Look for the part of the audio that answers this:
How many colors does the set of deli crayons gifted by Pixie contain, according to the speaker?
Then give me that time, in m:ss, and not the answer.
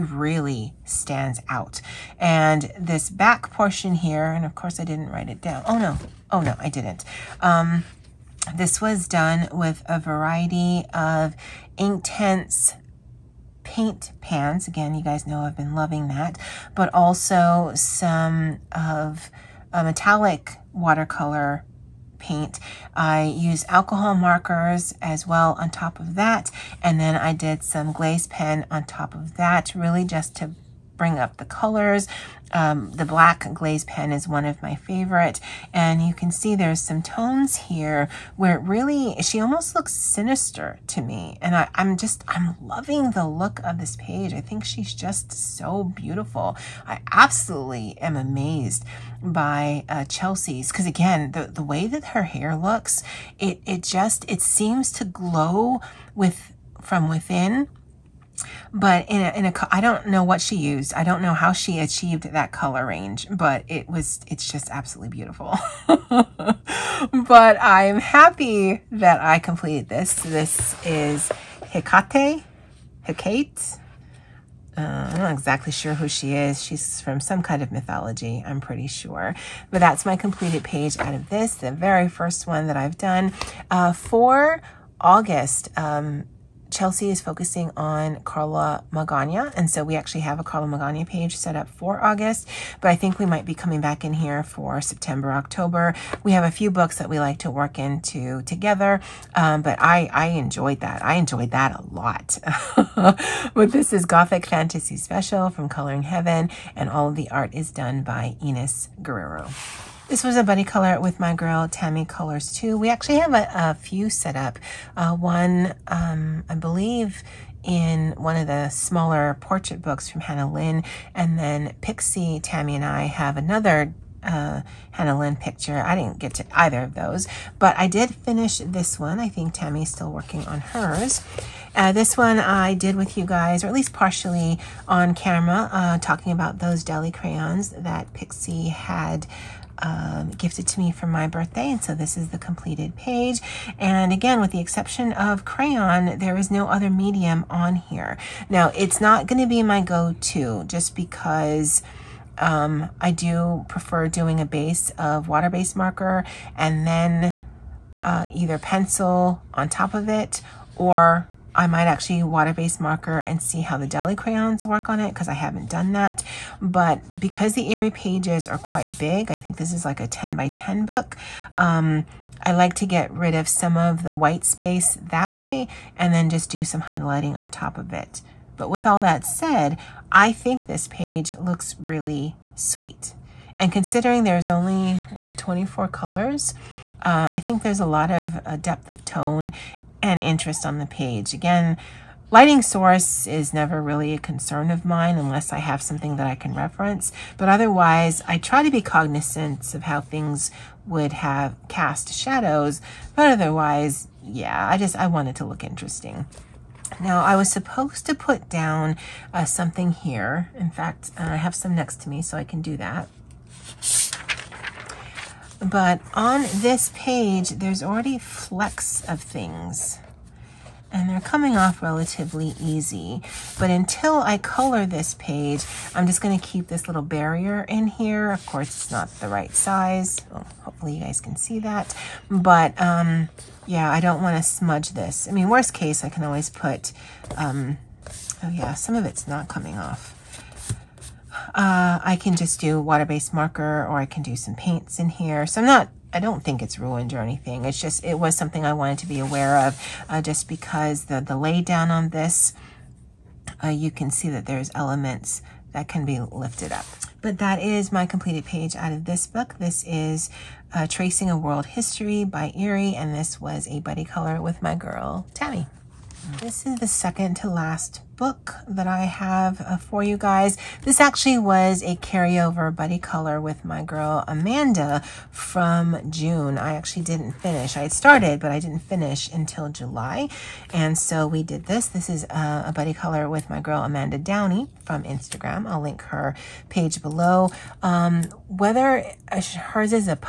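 3:05.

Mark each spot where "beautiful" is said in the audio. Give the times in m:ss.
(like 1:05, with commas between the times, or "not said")
0:45, 1:05.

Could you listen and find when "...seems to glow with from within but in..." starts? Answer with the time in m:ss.
0:54.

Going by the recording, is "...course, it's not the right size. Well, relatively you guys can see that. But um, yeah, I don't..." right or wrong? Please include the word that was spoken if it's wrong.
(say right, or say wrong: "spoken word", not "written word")
wrong: "hopefully", not "relatively".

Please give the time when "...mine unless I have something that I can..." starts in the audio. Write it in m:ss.
3:14.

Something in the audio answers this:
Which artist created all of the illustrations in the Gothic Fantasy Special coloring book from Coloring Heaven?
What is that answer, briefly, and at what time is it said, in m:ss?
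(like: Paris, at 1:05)
Enos Guerrero, at 1:48.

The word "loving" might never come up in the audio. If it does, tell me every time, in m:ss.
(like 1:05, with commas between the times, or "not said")
0:15, 0:42.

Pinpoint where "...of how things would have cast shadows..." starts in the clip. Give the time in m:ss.
3:19.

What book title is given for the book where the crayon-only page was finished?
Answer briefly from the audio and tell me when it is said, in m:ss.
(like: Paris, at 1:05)
Tracing a World History, at 4:20.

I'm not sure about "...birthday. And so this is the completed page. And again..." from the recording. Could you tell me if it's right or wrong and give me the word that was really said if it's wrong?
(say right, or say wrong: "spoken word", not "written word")
right.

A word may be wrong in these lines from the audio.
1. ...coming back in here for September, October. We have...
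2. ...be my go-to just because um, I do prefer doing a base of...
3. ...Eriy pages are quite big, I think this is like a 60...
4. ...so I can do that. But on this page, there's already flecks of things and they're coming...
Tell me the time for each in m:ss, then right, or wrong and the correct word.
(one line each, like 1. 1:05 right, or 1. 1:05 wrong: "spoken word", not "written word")
1. 1:33 right
2. 2:29 right
3. 2:47 wrong: "10", not "60"
4. 3:32 right.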